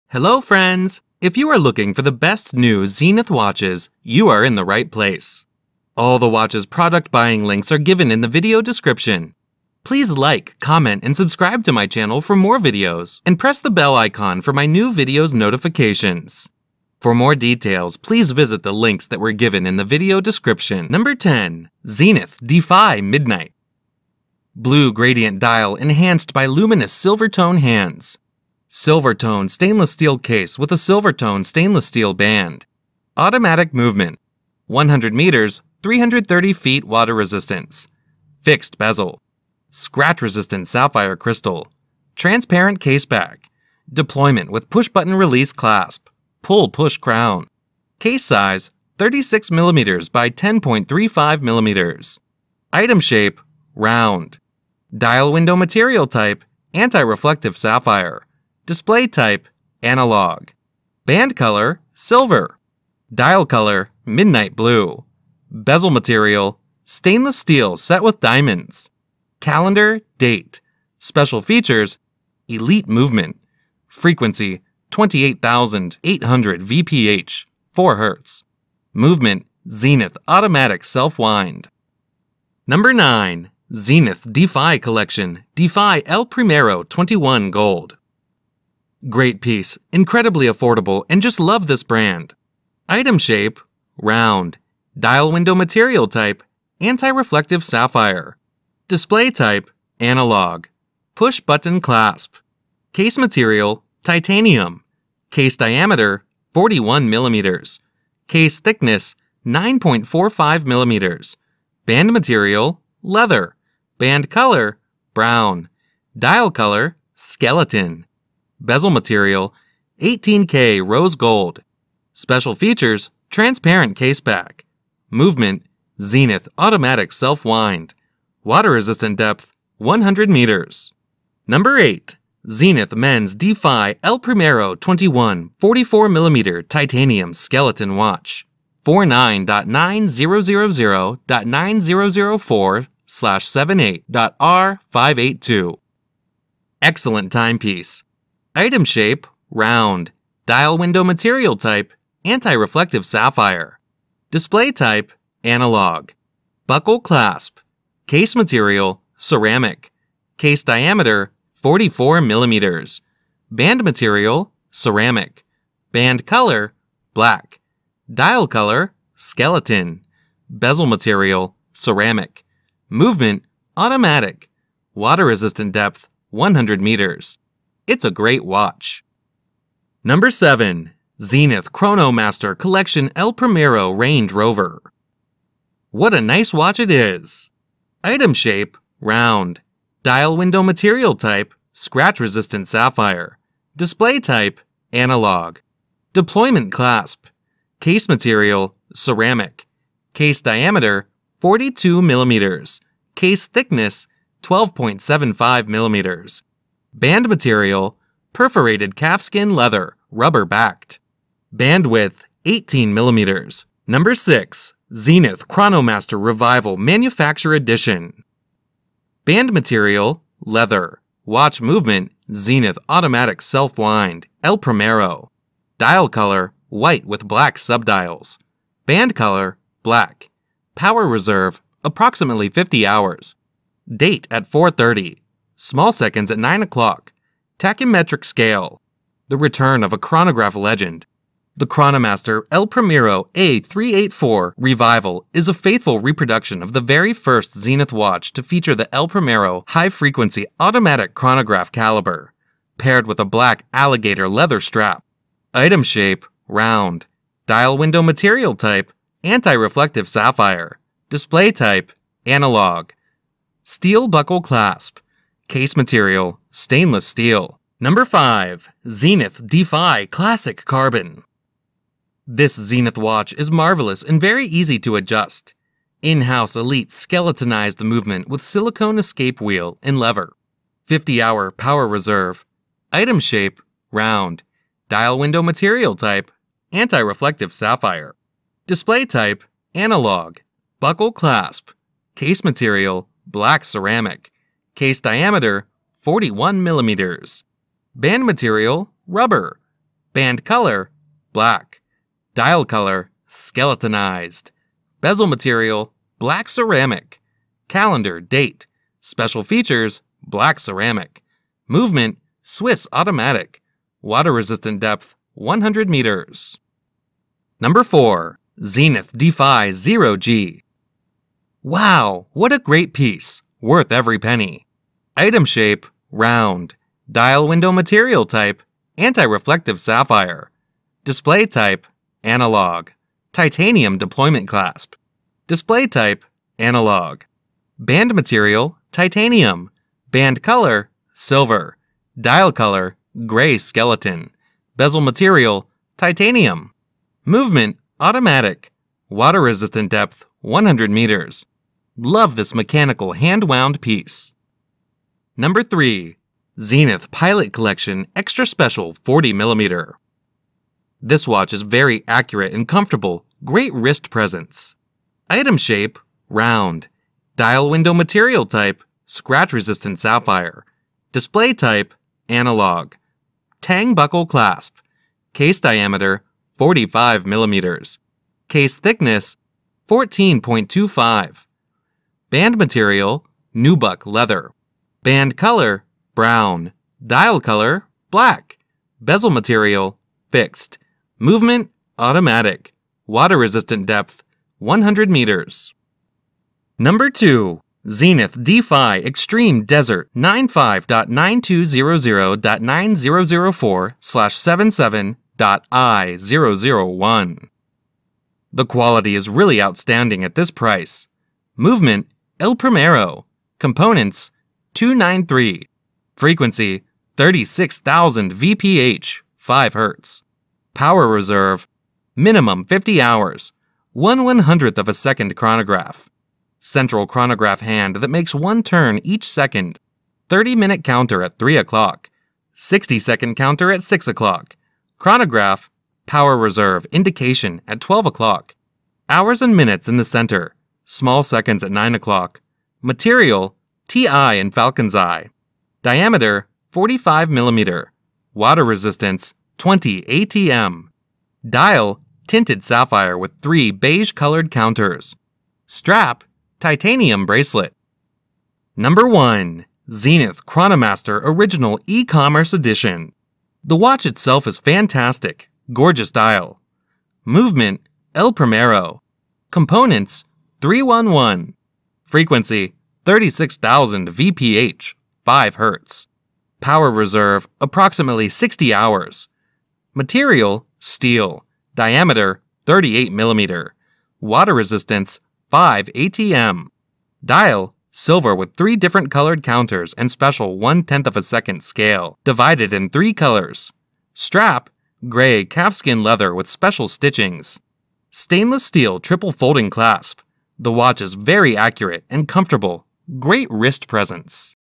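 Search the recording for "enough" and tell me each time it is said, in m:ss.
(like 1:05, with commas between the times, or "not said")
not said.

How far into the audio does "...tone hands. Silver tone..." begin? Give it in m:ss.
0:27.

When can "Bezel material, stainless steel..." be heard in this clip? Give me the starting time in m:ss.
1:05.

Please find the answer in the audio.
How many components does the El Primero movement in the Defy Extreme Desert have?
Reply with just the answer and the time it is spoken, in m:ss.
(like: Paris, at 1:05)
293, at 6:54.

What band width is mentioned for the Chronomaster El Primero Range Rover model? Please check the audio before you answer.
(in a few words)
18 mm.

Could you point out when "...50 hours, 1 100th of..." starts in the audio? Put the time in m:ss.
7:02.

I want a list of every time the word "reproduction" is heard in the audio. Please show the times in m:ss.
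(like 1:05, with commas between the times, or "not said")
4:05.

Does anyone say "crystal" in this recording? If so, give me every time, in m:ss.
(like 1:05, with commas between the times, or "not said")
0:41.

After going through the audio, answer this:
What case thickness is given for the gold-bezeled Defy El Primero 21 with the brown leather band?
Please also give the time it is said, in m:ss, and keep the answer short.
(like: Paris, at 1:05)
9.45 mm, at 1:49.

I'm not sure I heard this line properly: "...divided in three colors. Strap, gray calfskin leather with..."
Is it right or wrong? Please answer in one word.
right.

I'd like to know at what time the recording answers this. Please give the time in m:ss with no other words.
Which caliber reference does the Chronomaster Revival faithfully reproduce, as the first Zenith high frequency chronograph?
4:03.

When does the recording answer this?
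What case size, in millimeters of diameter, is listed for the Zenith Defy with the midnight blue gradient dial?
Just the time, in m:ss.
0:48.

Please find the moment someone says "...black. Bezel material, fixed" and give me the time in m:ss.
6:28.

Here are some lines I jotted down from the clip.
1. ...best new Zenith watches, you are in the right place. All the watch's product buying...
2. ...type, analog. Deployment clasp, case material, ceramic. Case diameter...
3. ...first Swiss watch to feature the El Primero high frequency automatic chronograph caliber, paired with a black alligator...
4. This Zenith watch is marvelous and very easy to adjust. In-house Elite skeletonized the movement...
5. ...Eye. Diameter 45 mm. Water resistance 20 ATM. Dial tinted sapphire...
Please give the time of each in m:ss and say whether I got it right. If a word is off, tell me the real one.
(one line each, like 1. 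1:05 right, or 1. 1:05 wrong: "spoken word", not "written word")
1. 0:02 right
2. 3:14 right
3. 4:07 wrong: "Zenith", not "Swiss"
4. 4:32 right
5. 7:24 right.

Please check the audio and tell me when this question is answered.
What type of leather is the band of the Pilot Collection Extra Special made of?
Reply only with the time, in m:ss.
6:23.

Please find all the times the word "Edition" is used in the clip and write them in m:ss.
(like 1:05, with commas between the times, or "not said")
3:37, 7:42.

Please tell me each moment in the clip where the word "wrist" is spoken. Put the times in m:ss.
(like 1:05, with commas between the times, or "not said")
6:03, 8:23.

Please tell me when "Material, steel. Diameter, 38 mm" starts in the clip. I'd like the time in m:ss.
7:59.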